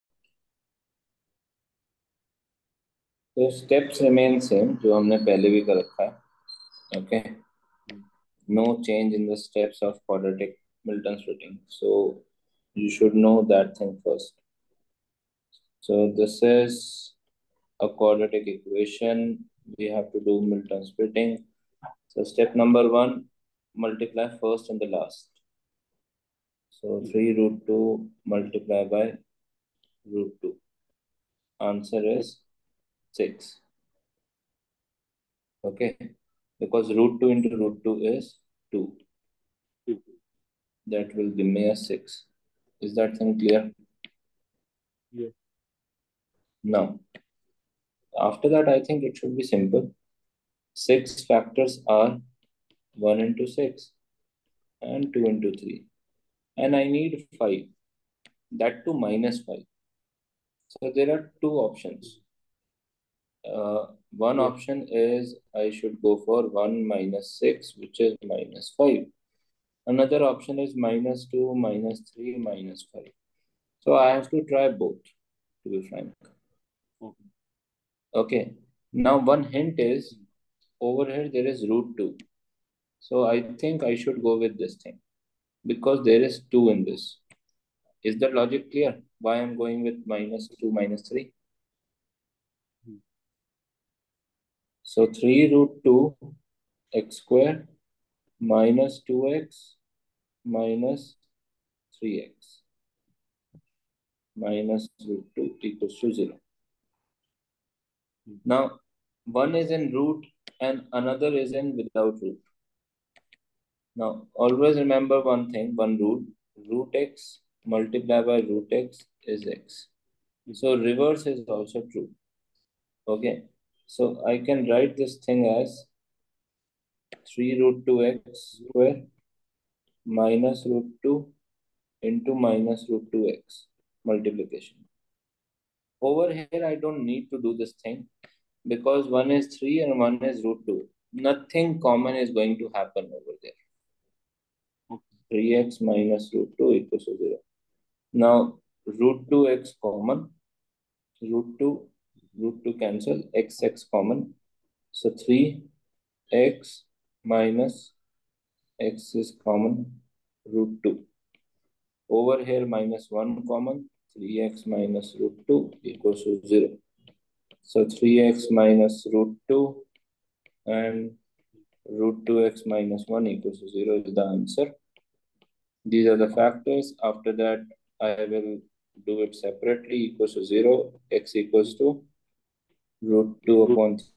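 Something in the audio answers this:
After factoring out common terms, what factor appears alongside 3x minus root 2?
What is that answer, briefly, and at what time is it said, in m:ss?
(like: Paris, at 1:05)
root 2x minus 1, at 2:51.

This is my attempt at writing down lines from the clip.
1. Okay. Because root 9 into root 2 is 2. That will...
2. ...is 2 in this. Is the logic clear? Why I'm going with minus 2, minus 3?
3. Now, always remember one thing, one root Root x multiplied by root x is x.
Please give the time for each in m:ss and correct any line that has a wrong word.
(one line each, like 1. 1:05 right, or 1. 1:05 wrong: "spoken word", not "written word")
1. 0:35 wrong: "2", not "9"
2. 1:26 right
3. 1:53 right.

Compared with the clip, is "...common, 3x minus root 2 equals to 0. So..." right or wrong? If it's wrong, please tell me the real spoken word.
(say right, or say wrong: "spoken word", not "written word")
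right.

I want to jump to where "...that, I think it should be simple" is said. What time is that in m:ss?
0:48.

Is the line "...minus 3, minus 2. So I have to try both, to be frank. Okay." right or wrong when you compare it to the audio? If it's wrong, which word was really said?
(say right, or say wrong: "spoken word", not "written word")
wrong: "5", not "2".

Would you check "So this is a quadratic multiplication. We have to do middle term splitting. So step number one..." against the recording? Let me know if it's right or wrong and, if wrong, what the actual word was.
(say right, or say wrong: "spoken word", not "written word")
wrong: "equation", not "multiplication".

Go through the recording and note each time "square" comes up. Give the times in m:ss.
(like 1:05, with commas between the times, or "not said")
1:37, 2:08.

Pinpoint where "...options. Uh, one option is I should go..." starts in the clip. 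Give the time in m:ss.
1:01.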